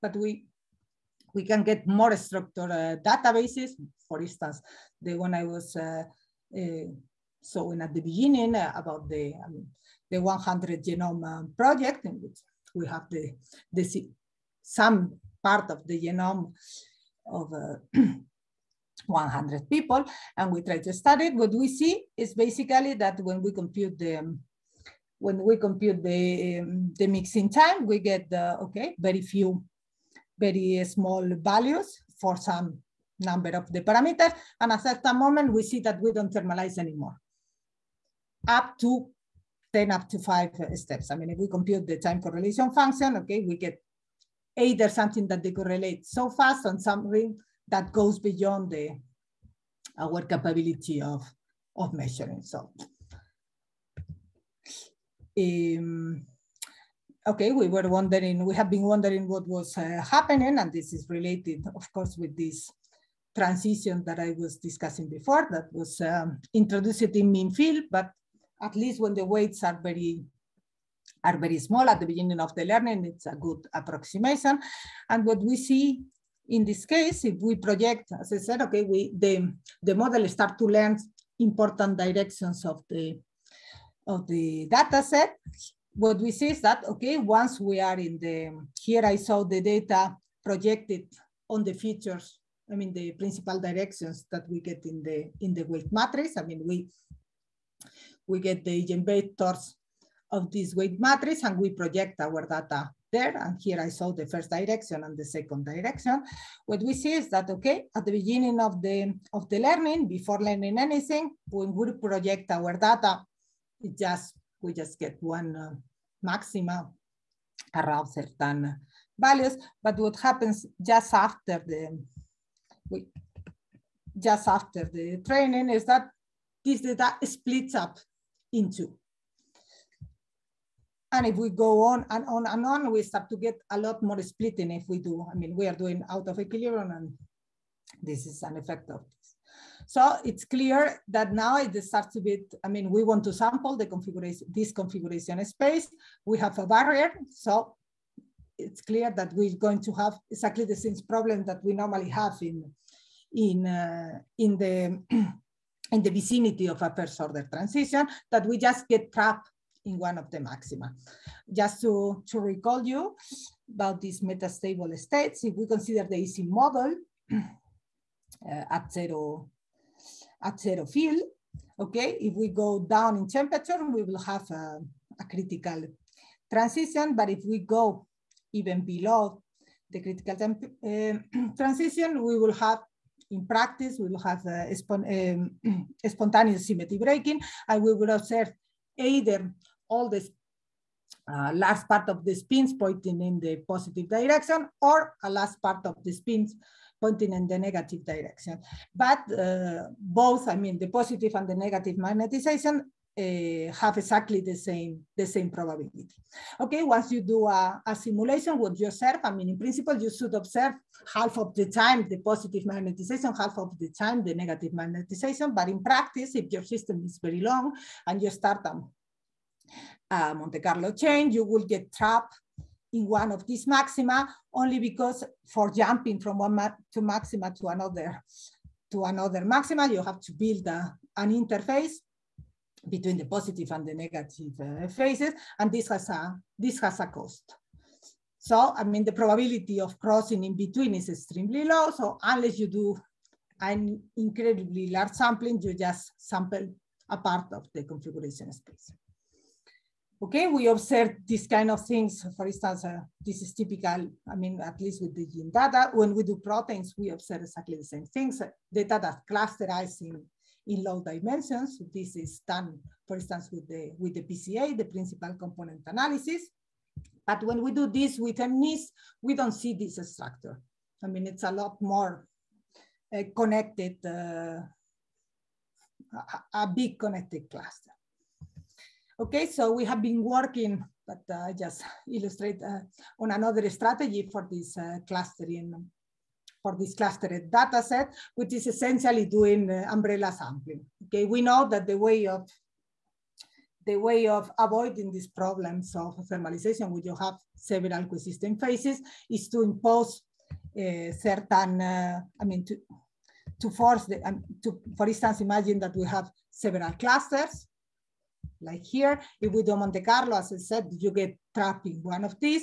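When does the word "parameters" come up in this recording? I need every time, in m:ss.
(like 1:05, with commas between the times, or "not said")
0:33.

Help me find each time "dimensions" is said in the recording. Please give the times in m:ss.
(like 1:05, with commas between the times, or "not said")
4:21.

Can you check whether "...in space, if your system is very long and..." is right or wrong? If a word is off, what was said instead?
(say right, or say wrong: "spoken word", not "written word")
wrong: "practice", not "space".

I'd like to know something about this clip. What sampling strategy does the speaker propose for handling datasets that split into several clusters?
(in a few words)
umbrella sampling.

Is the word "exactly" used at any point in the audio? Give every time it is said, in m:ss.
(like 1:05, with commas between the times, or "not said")
2:30, 3:23, 4:17.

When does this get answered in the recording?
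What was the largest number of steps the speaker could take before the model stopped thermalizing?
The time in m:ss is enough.
0:40.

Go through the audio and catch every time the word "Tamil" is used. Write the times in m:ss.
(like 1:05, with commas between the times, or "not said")
not said.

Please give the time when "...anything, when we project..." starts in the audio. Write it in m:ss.
1:50.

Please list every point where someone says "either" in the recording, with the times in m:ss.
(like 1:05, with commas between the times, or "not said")
0:44, 3:08.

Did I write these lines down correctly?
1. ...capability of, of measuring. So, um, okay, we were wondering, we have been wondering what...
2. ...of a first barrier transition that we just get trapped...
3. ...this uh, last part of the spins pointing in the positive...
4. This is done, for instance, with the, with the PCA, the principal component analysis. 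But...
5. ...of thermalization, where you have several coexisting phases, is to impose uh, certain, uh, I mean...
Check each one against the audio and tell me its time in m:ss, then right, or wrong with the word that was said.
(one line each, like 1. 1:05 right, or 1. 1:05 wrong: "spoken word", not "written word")
1. 0:50 right
2. 2:36 wrong: "order", not "barrier"
3. 3:10 right
4. 4:21 right
5. 4:55 right.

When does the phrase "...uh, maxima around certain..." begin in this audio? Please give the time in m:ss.
1:55.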